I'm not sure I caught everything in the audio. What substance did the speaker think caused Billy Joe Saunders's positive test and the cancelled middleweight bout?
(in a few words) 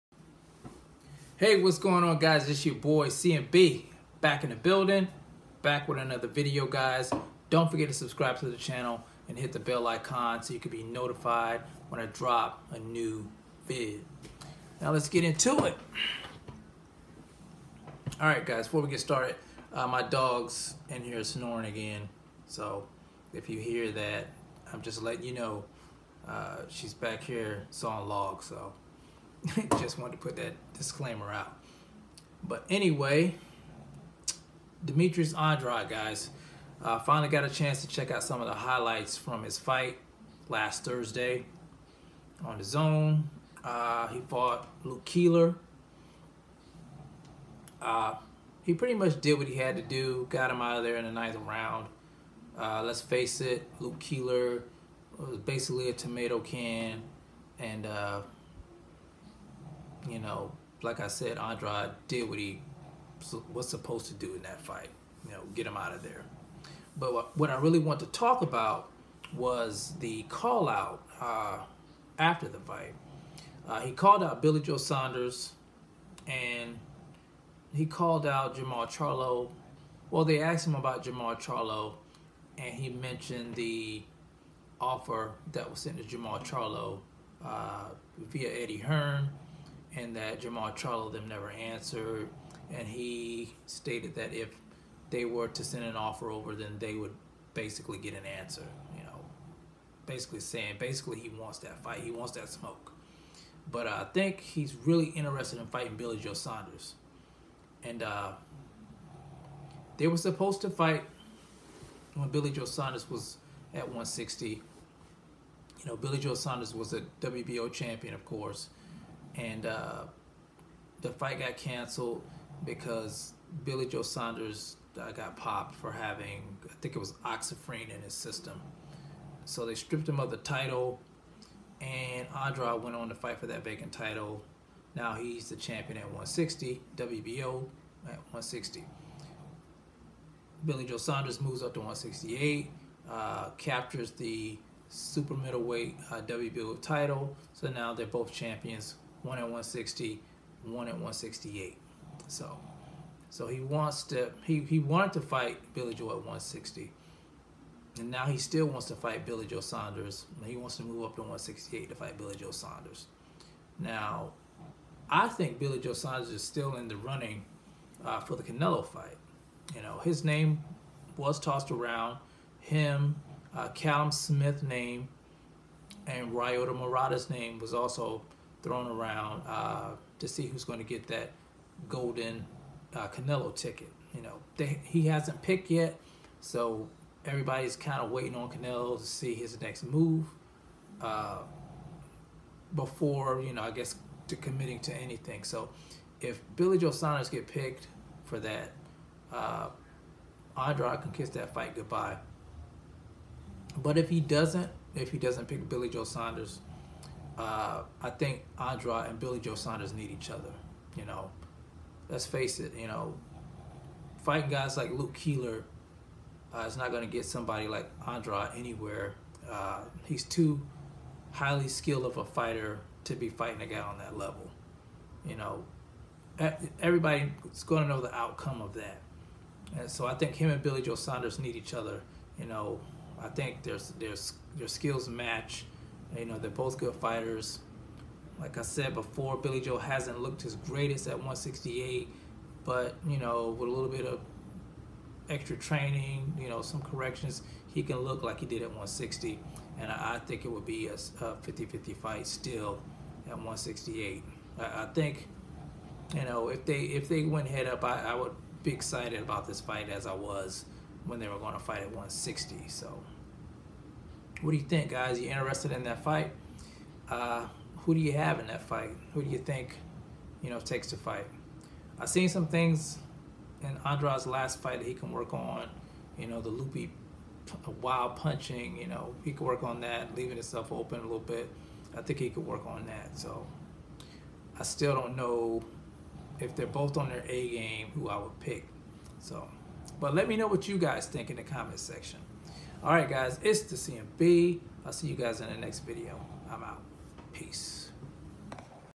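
oxyphene.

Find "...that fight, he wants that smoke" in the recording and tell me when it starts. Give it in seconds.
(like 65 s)
101 s.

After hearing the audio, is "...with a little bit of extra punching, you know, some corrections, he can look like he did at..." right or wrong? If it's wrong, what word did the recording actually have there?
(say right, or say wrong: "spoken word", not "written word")
wrong: "training", not "punching".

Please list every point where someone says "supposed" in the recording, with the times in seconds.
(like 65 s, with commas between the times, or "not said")
63 s, 110 s.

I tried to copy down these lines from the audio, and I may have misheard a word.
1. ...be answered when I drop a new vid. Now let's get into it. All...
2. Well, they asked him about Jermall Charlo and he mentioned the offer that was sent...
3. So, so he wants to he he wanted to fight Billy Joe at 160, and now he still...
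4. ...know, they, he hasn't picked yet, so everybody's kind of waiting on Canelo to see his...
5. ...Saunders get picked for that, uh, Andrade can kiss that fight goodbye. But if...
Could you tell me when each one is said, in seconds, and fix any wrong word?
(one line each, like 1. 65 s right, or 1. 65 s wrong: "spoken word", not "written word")
1. 10 s wrong: "notified", not "answered"
2. 80 s right
3. 152 s right
4. 184 s right
5. 196 s right.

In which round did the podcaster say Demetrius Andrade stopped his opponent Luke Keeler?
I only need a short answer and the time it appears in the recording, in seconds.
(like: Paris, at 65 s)
9th round, at 51 s.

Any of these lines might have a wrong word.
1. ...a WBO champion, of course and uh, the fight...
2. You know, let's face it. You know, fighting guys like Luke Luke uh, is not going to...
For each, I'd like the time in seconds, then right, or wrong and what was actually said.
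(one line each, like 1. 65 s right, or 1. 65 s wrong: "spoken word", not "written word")
1. 116 s right
2. 210 s wrong: "Keeler", not "Luke".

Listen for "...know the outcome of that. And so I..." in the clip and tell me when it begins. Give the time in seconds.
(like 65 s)
227 s.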